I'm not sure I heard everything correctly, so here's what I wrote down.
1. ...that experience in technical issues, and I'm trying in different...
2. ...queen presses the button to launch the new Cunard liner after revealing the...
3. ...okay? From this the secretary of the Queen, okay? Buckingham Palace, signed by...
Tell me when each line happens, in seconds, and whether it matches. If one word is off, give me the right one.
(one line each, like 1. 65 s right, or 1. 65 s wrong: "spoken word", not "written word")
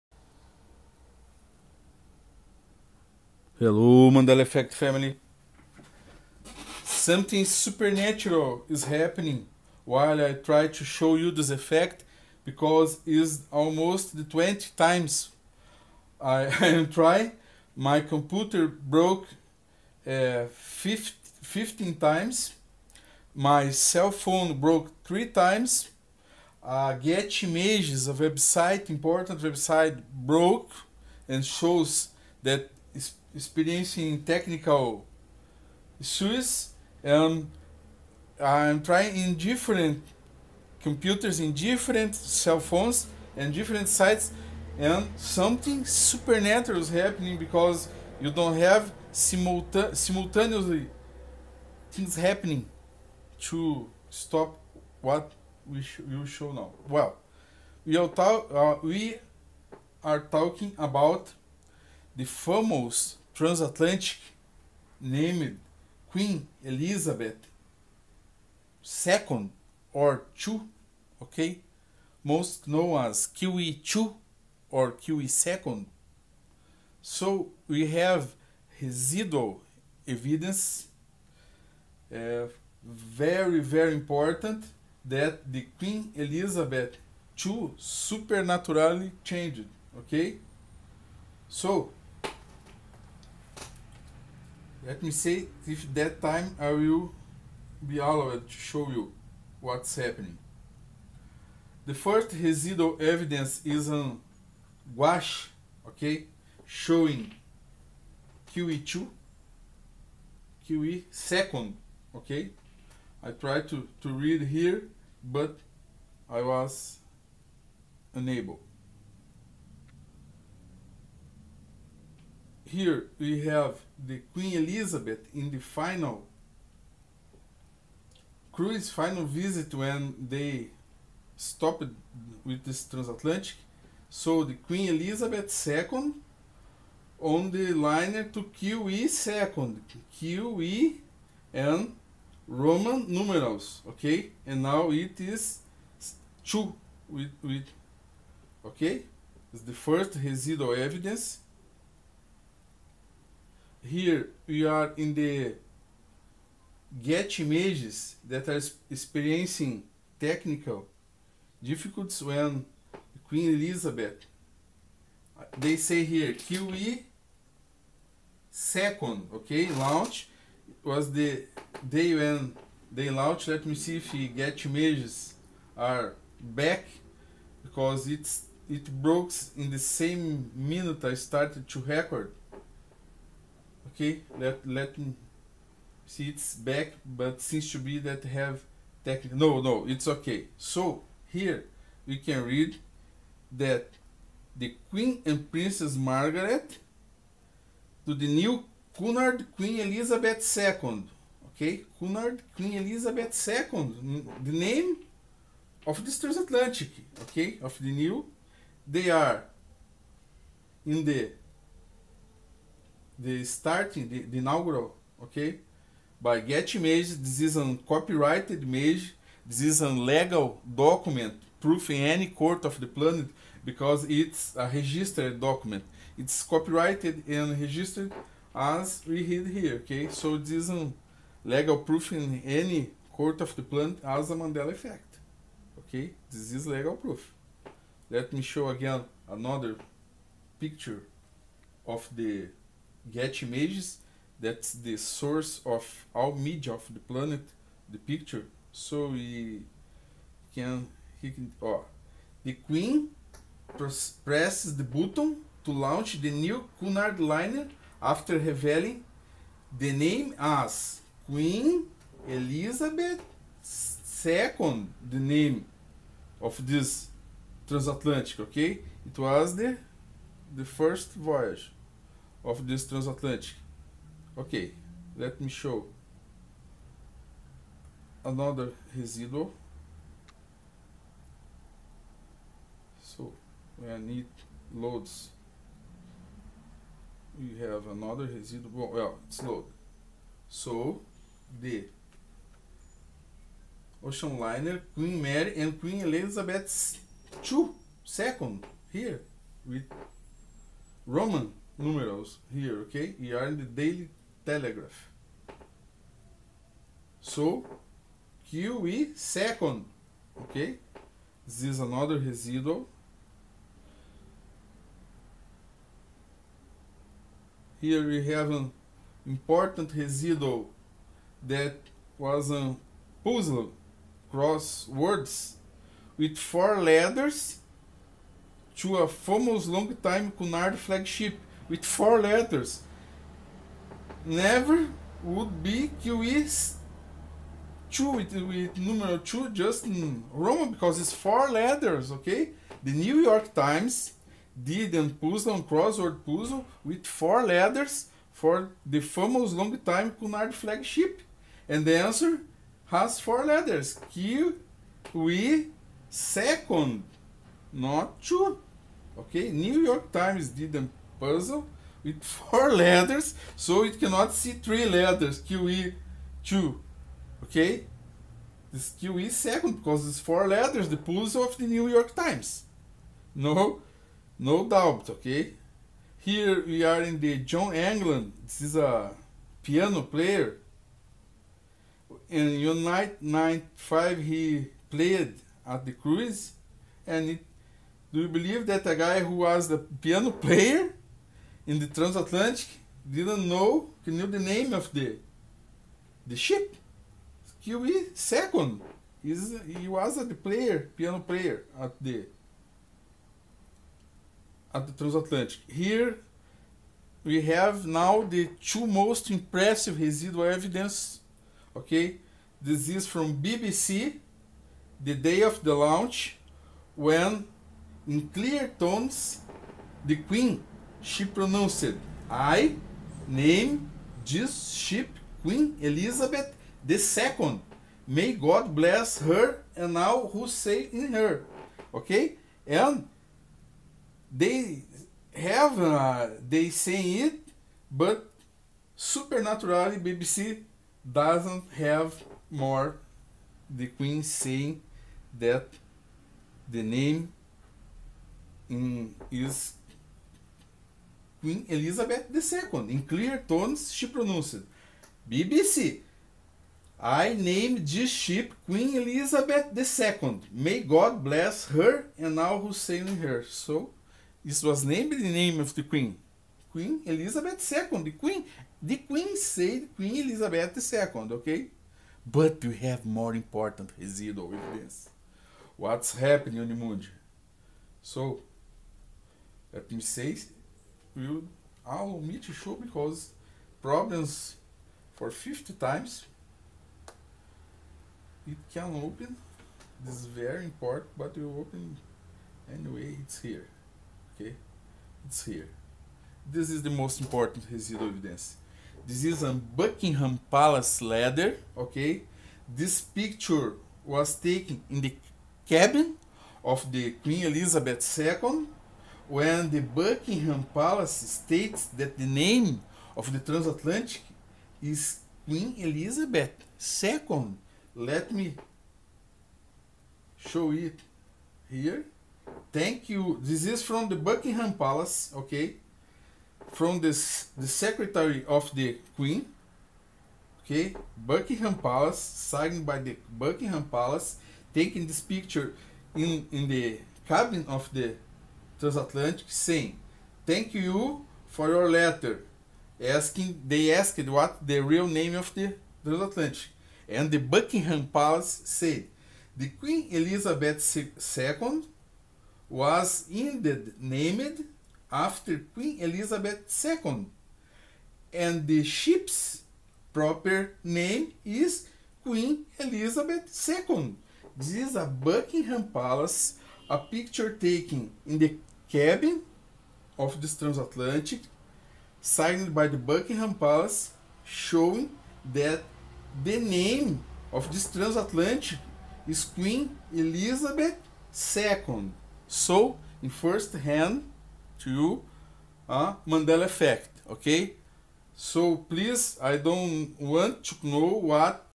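1. 32 s right
2. 252 s right
3. 525 s right.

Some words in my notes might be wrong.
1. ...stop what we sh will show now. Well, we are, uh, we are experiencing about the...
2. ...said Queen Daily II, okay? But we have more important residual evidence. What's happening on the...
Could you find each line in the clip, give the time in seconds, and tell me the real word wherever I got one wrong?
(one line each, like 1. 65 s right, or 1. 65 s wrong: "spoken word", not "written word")
1. 54 s wrong: "talking", not "experiencing"
2. 469 s wrong: "Elizabeth", not "Daily".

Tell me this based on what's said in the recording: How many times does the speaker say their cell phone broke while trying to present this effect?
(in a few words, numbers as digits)
3.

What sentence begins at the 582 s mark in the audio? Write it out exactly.
So, in first hand, to uh, Mandela effect, okay?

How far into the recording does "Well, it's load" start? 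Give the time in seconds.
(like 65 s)
288 s.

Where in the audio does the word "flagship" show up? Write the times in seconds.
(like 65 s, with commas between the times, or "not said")
330 s, 350 s.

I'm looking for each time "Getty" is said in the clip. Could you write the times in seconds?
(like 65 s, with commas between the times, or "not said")
26 s, 157 s, 174 s, 216 s, 243 s.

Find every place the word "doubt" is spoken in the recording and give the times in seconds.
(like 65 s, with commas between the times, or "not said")
374 s.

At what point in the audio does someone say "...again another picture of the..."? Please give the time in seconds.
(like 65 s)
238 s.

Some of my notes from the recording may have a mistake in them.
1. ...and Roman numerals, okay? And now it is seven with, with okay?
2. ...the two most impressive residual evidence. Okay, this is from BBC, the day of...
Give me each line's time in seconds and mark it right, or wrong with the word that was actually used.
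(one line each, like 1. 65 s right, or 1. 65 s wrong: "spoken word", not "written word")
1. 141 s wrong: "two", not "seven"
2. 408 s right.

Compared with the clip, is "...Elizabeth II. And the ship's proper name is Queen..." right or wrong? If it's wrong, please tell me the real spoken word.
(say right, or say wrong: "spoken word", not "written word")
right.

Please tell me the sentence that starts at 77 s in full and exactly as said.
So we have residual evidence, uh, very, very important that the Queen Elizabeth II supernaturally changed, okay?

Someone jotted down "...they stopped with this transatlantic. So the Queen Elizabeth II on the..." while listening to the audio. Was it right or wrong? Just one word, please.
right.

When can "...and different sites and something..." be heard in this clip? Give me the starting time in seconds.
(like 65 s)
43 s.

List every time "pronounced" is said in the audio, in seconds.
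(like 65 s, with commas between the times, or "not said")
421 s, 454 s.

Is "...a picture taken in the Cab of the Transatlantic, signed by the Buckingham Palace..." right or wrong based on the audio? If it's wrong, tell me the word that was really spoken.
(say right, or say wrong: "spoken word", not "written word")
right.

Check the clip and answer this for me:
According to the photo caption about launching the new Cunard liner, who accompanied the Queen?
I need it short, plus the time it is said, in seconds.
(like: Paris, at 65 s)
Princess Margaret, at 195 s.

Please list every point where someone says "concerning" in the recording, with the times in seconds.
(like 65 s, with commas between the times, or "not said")
not said.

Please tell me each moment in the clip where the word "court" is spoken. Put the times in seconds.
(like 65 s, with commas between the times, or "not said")
222 s, 233 s.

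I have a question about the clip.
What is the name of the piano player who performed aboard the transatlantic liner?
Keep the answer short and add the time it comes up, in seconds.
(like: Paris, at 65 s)
John England, at 377 s.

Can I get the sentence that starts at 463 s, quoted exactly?
So, this was named the name of the Queen.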